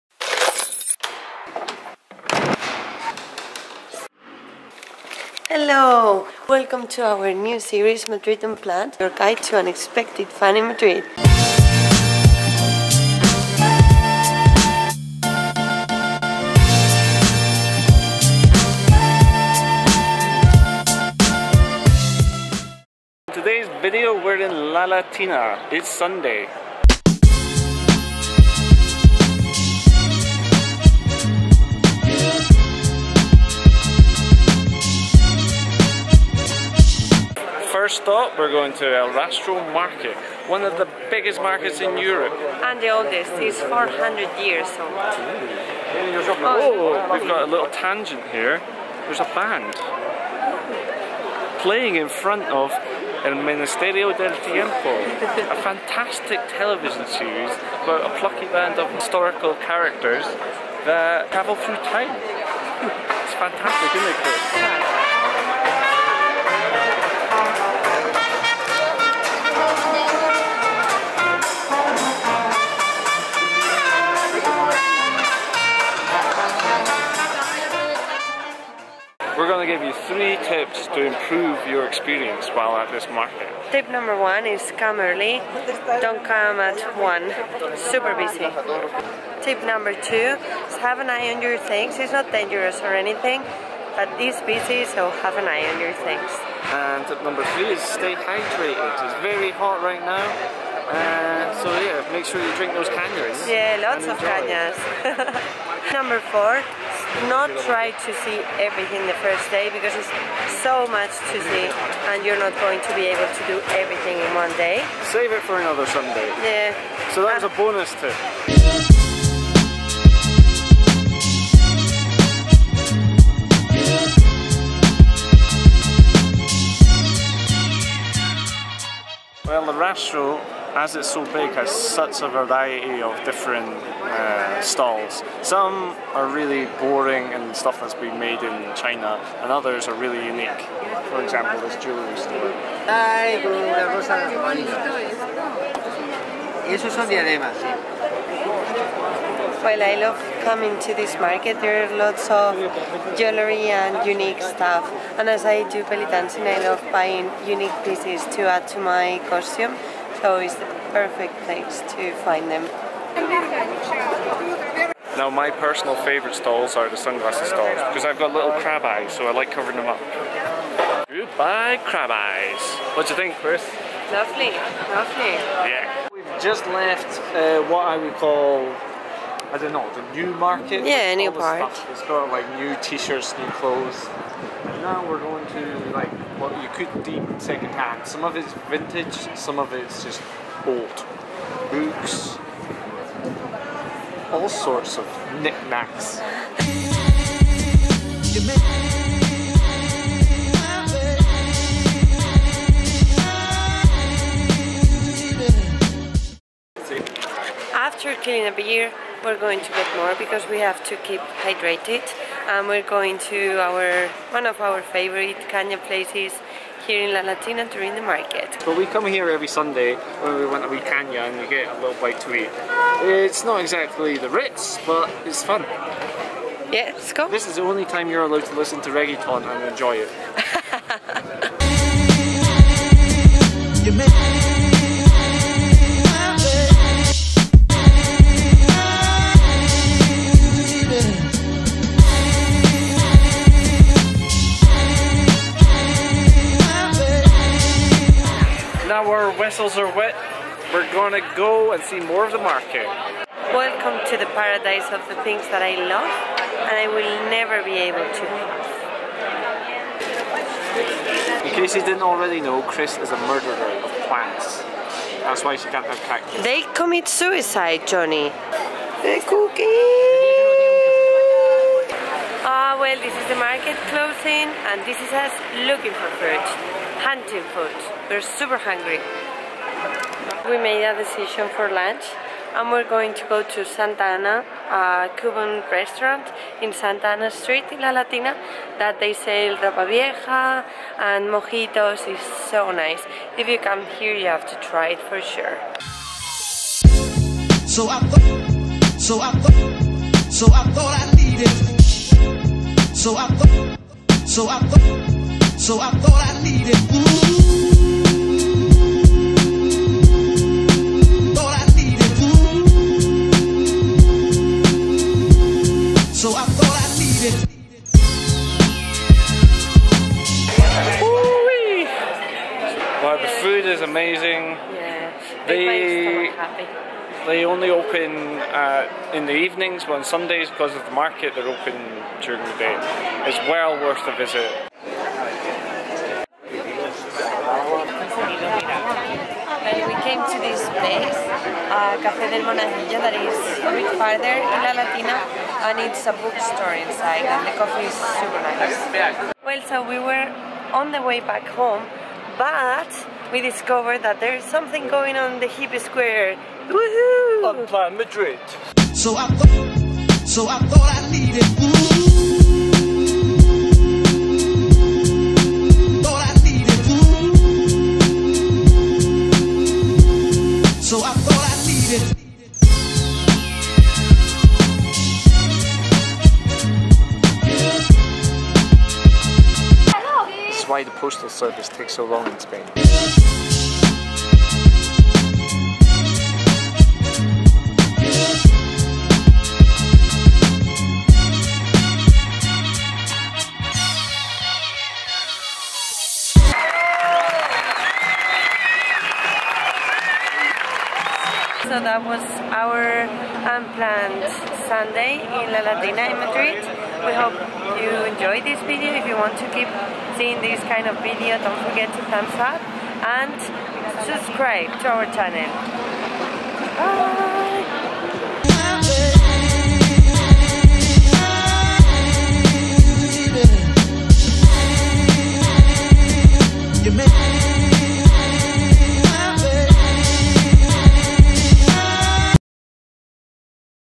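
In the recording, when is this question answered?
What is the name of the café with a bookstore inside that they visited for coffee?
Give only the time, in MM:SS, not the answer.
05:42.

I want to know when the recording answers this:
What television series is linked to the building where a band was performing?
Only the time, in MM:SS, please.
00:53.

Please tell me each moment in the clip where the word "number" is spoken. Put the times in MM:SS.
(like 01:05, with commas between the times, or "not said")
01:23, 01:29, 01:37, 01:45.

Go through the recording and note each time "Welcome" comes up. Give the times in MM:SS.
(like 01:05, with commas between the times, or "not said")
00:06, 04:13.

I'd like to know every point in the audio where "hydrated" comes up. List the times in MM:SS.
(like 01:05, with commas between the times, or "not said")
01:38, 03:31.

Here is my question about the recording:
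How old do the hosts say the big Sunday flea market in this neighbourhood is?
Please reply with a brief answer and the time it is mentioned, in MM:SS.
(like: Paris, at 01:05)
400 years, at 00:43.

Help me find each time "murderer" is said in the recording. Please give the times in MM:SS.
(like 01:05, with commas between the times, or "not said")
04:23.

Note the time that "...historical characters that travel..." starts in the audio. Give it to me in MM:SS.
00:58.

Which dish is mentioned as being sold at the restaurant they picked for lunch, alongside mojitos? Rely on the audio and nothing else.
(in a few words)
Ropa vieja.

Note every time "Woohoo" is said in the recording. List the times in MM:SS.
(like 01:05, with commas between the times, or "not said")
05:56.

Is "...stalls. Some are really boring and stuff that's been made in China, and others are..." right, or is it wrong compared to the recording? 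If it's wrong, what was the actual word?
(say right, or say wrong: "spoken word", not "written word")
right.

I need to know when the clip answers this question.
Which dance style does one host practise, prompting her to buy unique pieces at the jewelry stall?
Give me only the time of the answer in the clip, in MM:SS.
02:35.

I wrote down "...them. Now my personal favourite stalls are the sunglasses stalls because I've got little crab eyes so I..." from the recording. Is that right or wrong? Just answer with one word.
right.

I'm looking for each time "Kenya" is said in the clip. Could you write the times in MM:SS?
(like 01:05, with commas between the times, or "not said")
03:35, 03:40.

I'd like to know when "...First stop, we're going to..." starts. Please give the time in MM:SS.
00:37.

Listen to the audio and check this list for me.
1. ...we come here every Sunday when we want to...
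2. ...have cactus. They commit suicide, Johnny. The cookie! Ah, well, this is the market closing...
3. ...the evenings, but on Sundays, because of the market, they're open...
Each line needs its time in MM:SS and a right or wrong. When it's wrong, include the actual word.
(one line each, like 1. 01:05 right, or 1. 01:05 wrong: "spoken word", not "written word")
1. 03:38 right
2. 04:25 right
3. 05:29 right.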